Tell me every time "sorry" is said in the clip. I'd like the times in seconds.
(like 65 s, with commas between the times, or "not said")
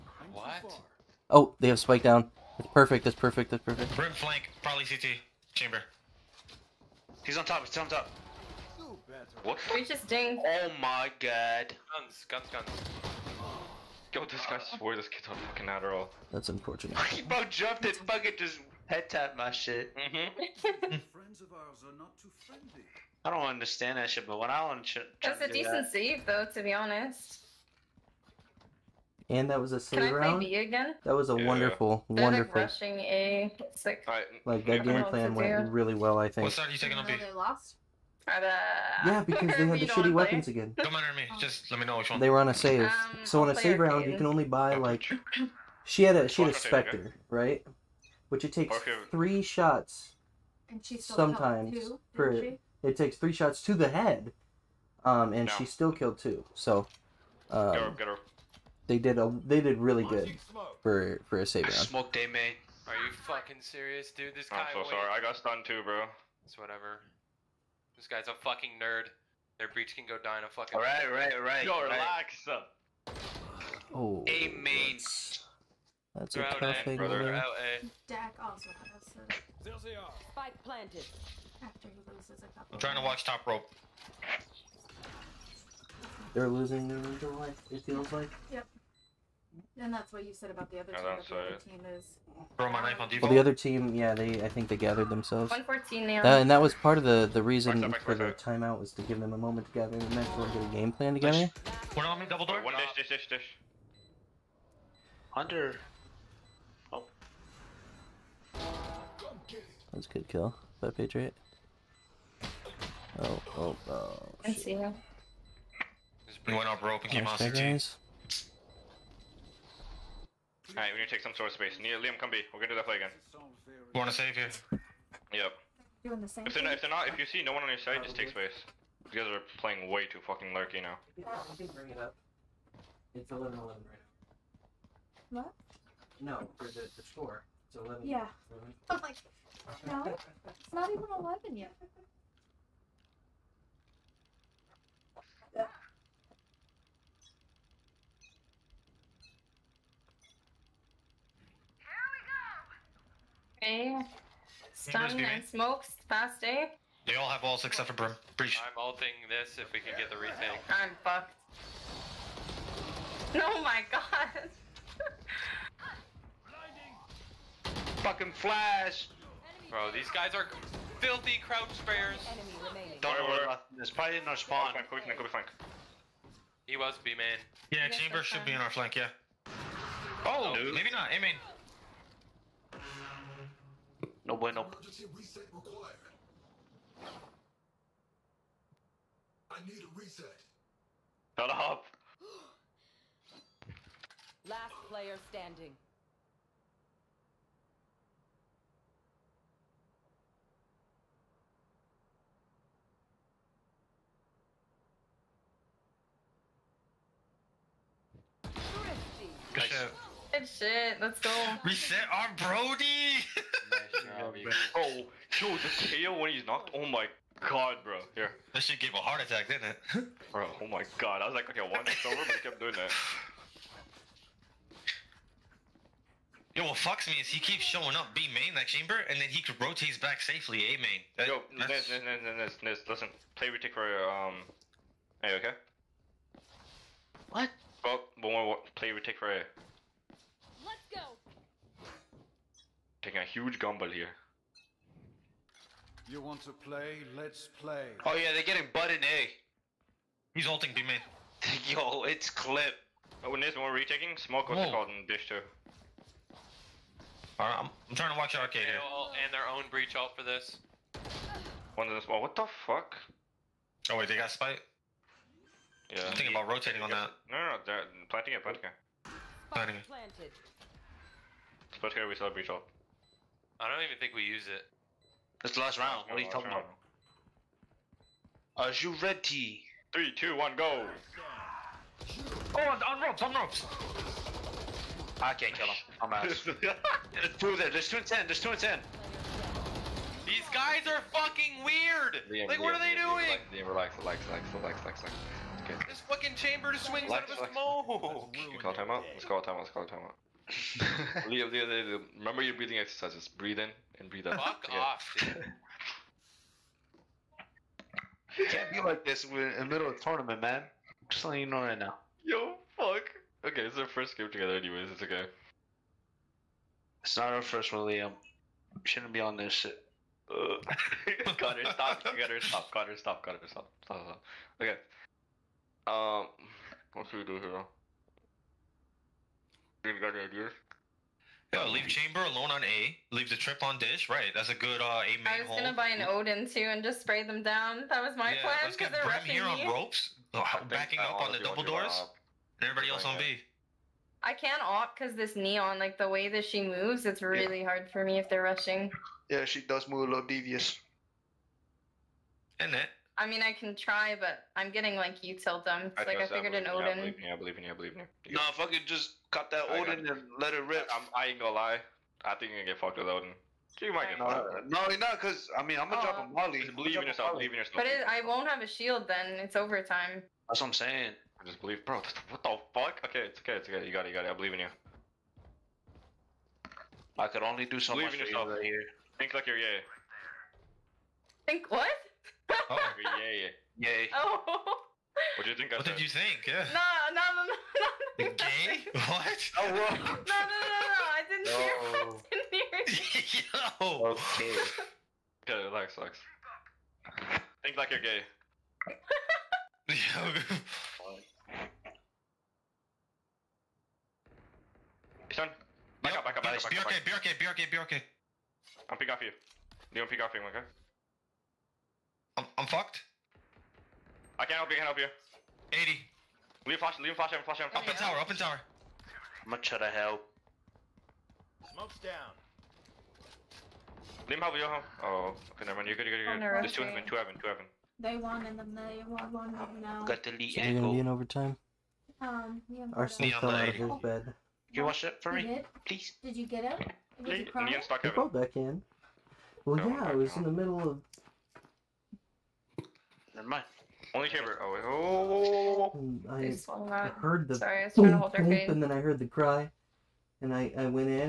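64 s, 447 s.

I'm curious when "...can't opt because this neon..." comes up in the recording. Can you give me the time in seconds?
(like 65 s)
344 s.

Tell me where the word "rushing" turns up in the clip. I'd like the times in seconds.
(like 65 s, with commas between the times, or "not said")
32 s, 348 s.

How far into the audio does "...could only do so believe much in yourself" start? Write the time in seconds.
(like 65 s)
377 s.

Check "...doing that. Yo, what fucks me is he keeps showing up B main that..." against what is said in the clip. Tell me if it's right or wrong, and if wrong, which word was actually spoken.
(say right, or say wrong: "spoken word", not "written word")
right.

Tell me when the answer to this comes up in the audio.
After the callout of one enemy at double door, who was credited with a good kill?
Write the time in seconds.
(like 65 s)
110 s.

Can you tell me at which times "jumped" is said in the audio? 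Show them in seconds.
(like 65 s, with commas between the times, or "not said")
17 s.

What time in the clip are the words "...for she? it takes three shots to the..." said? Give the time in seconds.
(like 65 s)
52 s.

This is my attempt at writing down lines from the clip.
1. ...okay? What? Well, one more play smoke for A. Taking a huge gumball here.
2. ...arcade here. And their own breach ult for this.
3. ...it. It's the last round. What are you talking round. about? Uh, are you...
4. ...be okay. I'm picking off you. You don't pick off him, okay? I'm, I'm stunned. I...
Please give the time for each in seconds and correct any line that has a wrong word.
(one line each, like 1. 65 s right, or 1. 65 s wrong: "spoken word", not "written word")
1. 235 s wrong: "retake", not "smoke"
2. 258 s right
3. 274 s right
4. 407 s wrong: "fucked", not "stunned".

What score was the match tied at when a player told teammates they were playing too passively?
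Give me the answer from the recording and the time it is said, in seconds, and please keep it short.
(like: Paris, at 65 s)
11-11, at 133 s.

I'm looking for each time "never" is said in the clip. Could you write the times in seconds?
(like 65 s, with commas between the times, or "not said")
425 s, 443 s.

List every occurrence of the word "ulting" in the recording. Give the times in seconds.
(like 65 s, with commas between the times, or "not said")
158 s, 250 s.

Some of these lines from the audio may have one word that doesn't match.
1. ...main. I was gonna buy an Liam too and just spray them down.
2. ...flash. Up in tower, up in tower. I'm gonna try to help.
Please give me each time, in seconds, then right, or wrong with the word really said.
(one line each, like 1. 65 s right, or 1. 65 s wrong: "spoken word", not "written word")
1. 335 s wrong: "Odin", not "Liam"
2. 417 s right.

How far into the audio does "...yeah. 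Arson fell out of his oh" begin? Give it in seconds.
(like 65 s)
432 s.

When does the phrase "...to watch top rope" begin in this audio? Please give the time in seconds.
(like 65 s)
82 s.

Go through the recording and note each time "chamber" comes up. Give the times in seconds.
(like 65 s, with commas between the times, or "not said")
5 s, 177 s, 228 s, 296 s, 331 s, 444 s.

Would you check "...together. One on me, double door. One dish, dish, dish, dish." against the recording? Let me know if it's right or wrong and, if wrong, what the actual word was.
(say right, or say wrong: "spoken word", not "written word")
right.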